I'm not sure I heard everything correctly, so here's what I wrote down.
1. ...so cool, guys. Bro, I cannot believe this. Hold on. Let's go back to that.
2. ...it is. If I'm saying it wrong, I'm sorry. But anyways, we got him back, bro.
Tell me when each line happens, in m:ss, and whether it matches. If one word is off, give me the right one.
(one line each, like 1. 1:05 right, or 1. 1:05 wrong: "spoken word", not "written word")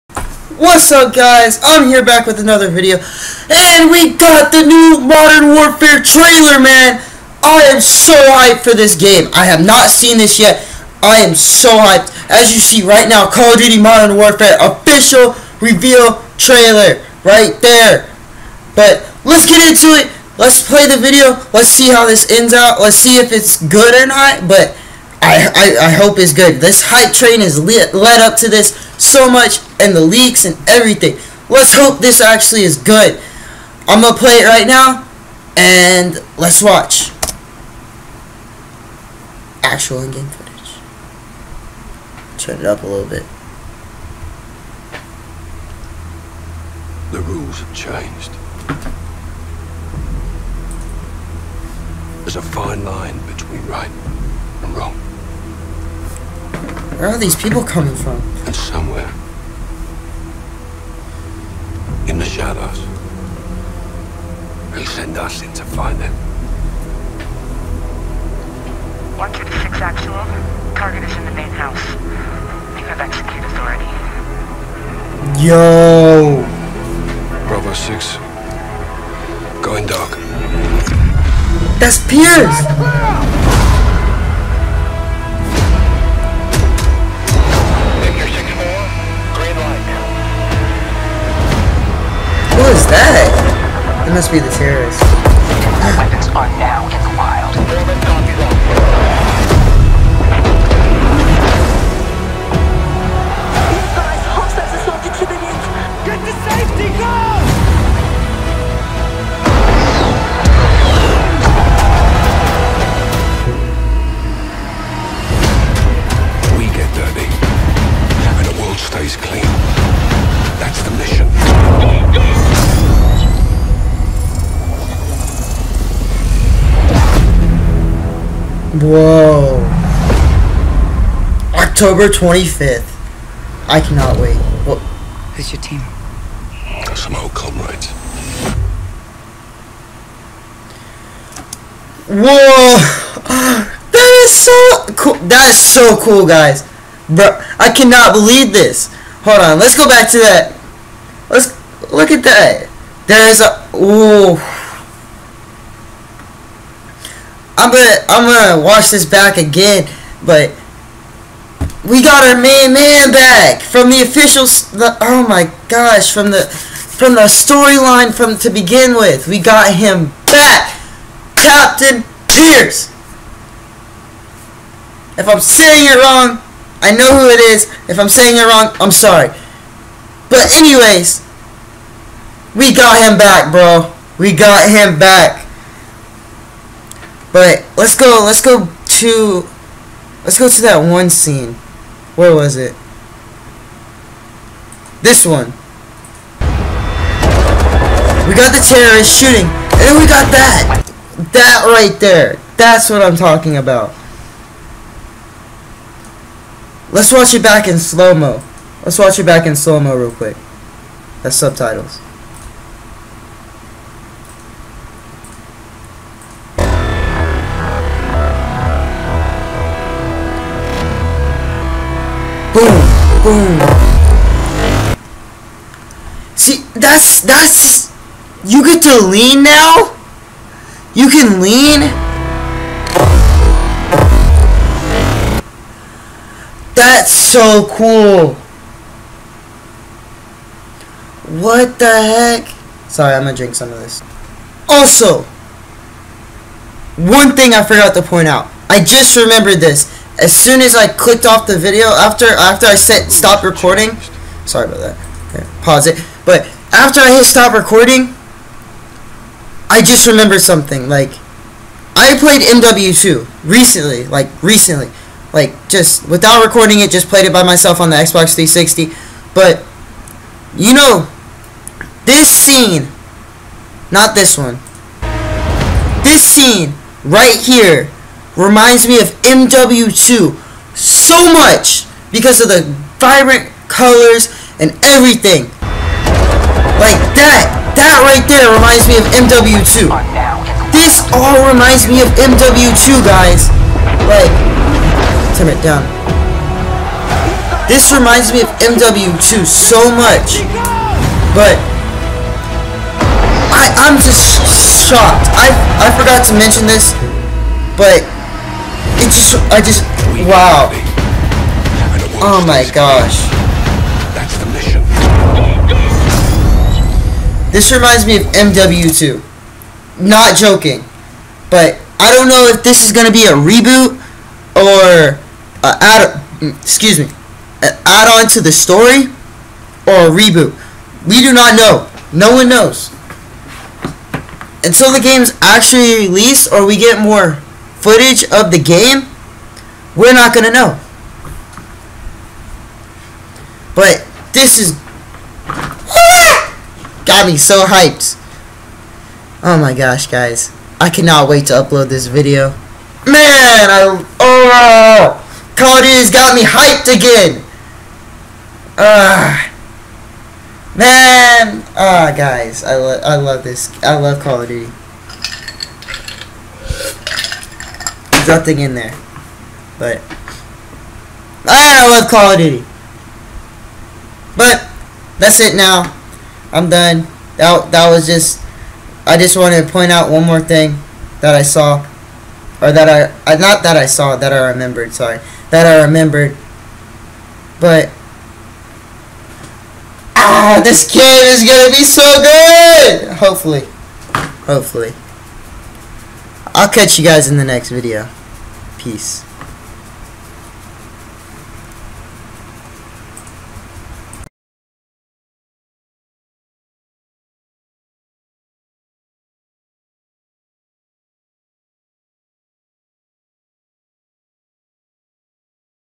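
1. 2:25 right
2. 2:57 right.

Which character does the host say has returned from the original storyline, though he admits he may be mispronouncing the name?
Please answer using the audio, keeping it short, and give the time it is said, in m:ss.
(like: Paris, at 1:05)
Captain Pierce, at 2:51.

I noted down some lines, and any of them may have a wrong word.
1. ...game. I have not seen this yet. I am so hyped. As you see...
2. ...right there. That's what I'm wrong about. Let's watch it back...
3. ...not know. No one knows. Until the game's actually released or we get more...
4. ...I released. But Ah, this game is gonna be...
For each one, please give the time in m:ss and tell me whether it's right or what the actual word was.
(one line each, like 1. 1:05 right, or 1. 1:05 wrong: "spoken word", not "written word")
1. 0:08 right
2. 3:21 wrong: "talking", not "wrong"
3. 5:31 right
4. 6:25 wrong: "remembered", not "released".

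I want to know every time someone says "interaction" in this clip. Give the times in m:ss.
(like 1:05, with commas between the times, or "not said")
not said.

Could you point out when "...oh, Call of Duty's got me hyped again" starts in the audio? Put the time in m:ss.
5:54.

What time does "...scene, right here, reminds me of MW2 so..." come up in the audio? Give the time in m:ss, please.
4:36.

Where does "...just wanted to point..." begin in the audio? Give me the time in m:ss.
6:19.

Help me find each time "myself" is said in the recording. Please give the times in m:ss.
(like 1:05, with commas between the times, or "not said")
4:27.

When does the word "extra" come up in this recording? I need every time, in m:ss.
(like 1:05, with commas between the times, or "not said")
not said.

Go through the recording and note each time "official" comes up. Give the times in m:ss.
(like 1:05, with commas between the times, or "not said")
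0:14, 2:44.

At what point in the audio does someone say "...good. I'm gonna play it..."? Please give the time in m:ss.
0:32.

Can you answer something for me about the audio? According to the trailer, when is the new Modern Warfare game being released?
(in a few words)
October 25th.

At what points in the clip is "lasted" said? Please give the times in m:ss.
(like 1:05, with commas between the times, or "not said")
not said.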